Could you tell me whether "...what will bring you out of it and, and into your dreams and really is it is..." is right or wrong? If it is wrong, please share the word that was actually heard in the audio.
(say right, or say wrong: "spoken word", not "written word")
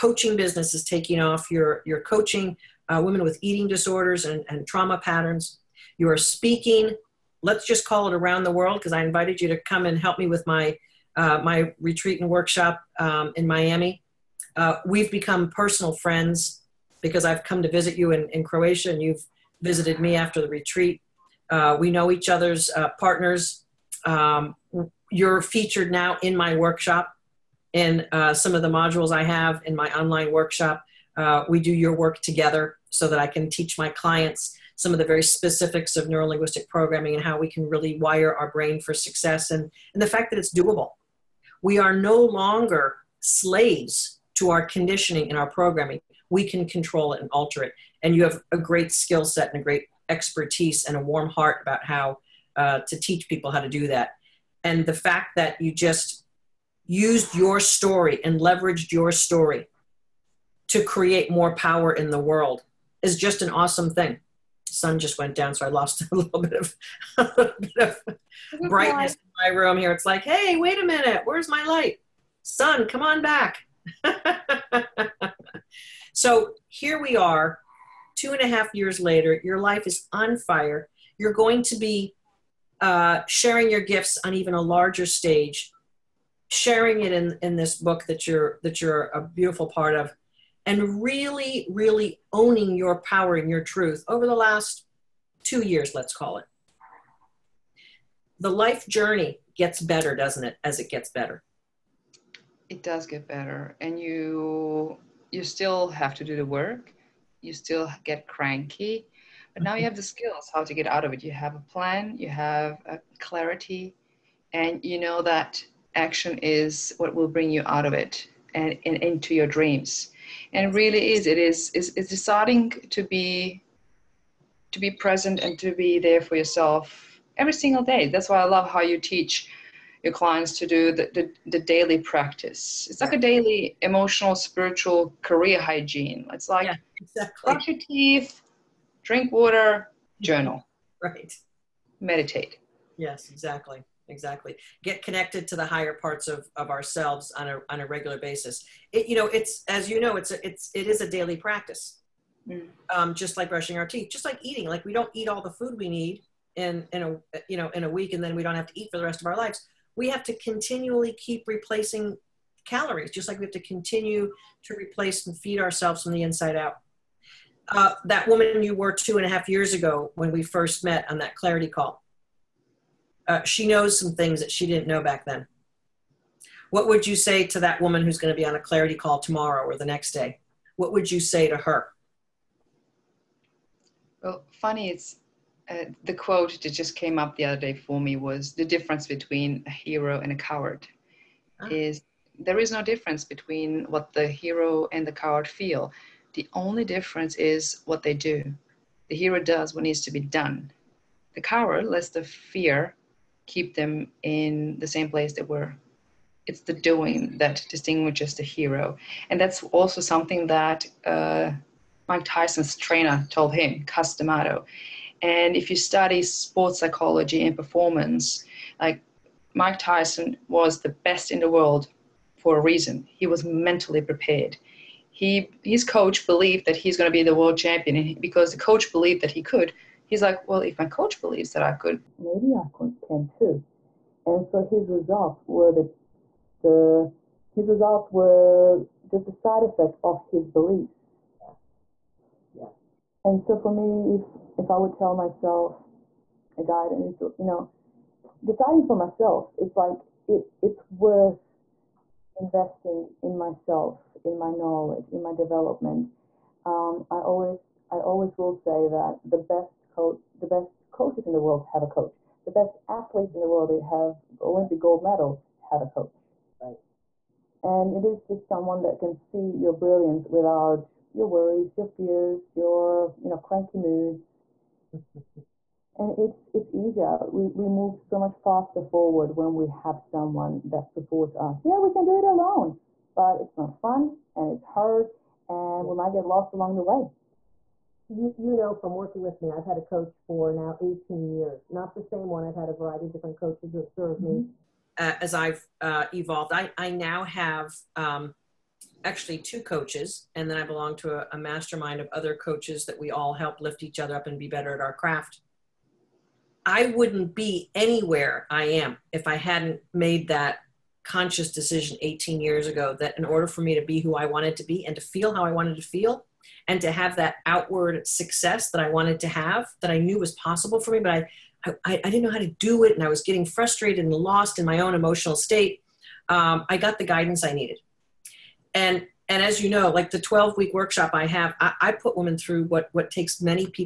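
right.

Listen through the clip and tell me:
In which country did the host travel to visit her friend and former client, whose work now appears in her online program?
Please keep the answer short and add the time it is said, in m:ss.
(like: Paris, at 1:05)
Croatia, at 0:18.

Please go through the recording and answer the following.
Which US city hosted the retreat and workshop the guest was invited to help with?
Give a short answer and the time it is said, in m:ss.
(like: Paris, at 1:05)
Miami, at 0:13.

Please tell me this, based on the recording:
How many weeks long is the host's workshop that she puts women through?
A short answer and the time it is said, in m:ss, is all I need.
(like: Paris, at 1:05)
12, at 5:30.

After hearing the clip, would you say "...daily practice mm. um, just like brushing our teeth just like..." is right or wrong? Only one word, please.
right.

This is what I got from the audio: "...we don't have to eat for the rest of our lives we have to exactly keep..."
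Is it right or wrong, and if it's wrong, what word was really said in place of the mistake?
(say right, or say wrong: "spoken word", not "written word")
wrong: "continually", not "exactly".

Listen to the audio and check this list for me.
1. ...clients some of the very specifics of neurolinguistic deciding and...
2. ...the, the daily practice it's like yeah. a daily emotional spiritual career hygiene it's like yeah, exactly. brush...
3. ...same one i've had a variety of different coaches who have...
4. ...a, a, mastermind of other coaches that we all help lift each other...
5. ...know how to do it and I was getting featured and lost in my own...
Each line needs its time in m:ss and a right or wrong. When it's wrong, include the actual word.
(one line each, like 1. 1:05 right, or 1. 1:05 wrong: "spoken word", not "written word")
1. 0:33 wrong: "programming", not "deciding"
2. 2:11 right
3. 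4:52 right
4. 5:01 right
5. 5:22 wrong: "frustrated", not "featured".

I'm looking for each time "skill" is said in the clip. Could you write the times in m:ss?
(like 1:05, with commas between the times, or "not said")
0:48, 1:50.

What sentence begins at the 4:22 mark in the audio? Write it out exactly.
The best athletes in the world they have Olympic gold medals have a coach.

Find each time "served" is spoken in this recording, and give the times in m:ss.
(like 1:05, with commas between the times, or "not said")
4:53.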